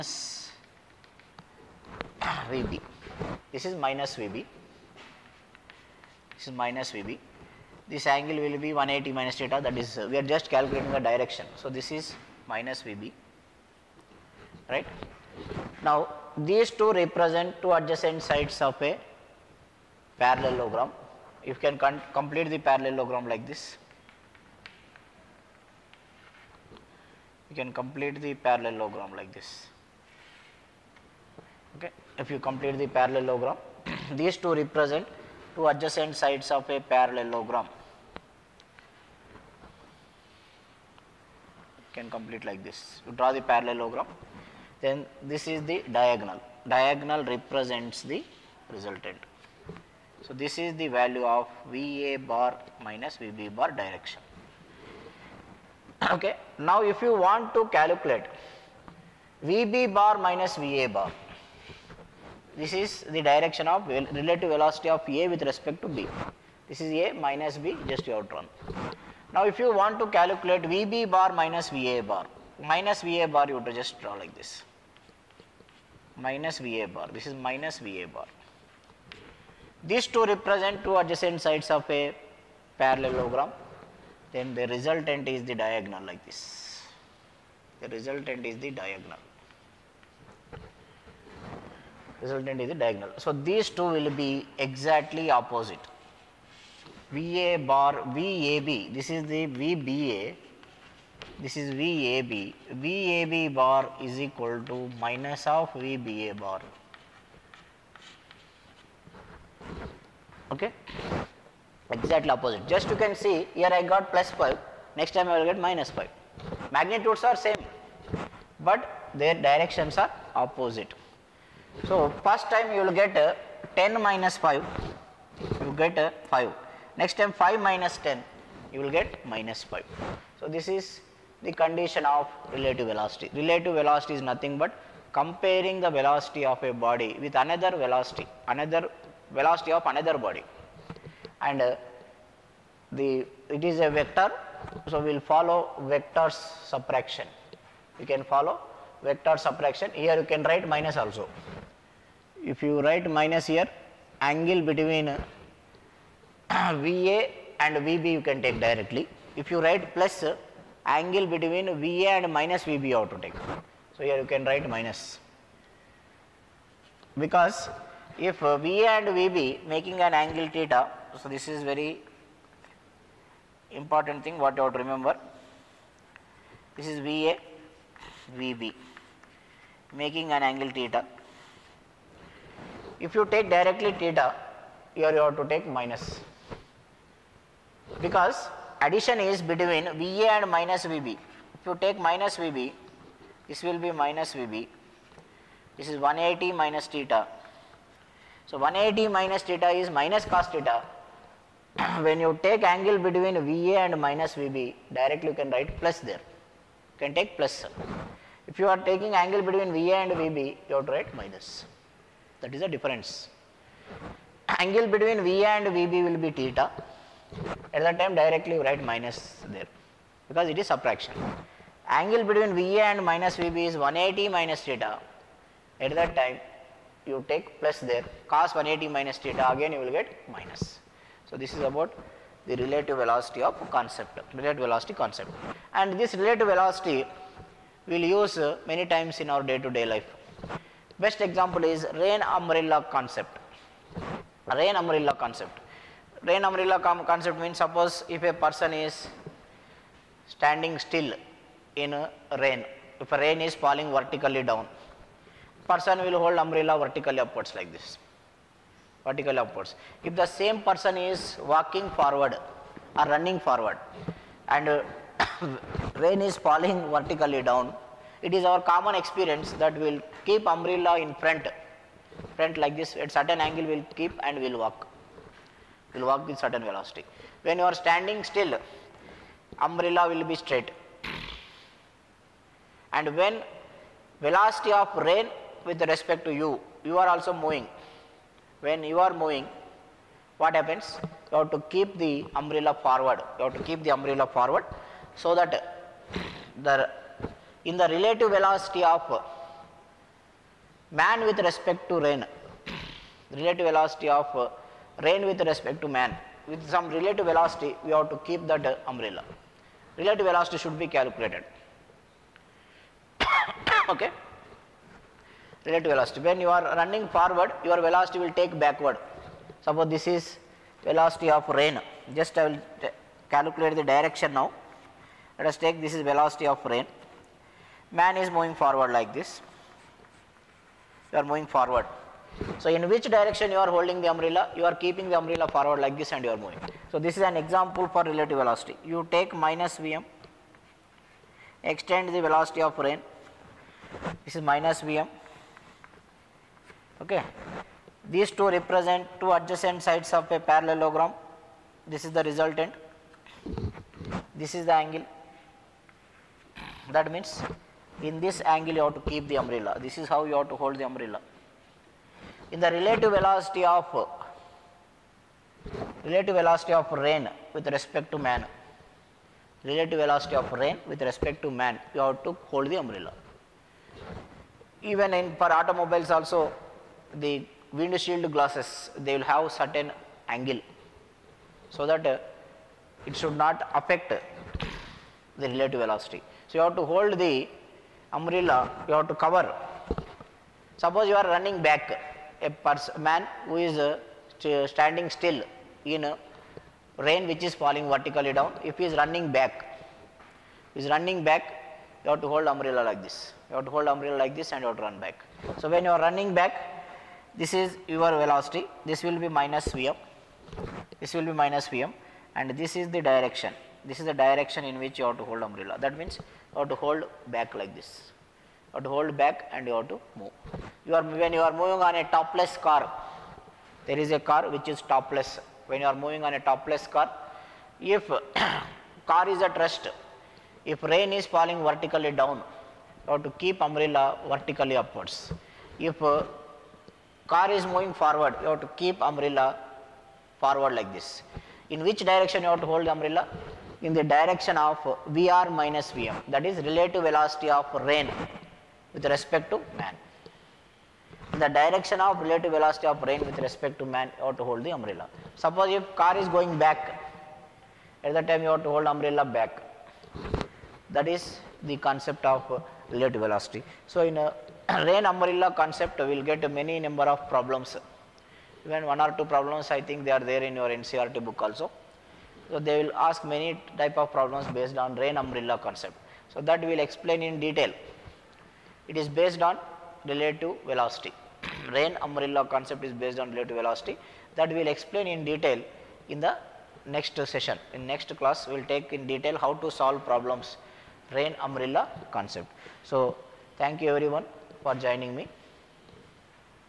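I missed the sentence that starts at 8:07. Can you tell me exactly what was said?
In next class we will take in detail how to solve problems rain umbrella concept.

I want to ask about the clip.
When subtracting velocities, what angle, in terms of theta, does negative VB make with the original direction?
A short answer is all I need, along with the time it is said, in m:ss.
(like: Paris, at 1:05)
180 minus theta, at 0:08.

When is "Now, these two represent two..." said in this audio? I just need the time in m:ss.
0:15.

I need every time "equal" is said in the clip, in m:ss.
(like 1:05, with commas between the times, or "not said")
1:44.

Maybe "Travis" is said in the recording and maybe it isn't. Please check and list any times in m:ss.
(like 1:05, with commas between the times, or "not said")
not said.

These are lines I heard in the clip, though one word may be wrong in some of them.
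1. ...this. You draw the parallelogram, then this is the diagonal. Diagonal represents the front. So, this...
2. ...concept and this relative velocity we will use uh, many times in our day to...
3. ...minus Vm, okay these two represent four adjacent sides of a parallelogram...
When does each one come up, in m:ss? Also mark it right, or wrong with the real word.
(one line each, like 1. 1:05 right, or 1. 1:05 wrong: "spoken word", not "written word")
1. 0:42 wrong: "resultant", not "front"
2. 3:54 right
3. 5:44 wrong: "two", not "four".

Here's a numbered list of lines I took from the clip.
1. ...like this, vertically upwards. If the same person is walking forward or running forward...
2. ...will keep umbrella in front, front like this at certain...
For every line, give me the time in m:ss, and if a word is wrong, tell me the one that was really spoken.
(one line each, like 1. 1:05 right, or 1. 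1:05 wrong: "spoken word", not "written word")
1. 4:17 right
2. 4:29 right.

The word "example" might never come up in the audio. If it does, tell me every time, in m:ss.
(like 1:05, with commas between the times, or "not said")
4:01, 5:37.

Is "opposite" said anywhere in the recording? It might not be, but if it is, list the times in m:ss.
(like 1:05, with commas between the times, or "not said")
1:35, 1:52, 2:00.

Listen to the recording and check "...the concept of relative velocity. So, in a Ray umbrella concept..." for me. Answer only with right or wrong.
right.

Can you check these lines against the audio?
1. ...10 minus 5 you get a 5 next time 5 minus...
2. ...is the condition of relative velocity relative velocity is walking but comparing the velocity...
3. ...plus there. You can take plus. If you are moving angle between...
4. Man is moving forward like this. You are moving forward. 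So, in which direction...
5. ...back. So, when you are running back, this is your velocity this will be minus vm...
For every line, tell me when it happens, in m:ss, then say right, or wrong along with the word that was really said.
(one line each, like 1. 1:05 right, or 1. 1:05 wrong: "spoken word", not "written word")
1. 2:03 right
2. 2:10 wrong: "nothing", not "walking"
3. 3:25 wrong: "taking", not "moving"
4. 5:27 right
5. 6:44 right.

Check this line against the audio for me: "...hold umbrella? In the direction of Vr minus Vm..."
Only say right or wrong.
right.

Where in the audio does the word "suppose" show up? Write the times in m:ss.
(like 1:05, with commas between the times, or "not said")
4:07, 5:19, 6:30, 7:35.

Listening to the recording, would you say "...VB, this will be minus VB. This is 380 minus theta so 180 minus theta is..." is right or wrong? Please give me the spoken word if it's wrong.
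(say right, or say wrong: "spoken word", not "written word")
wrong: "180", not "380".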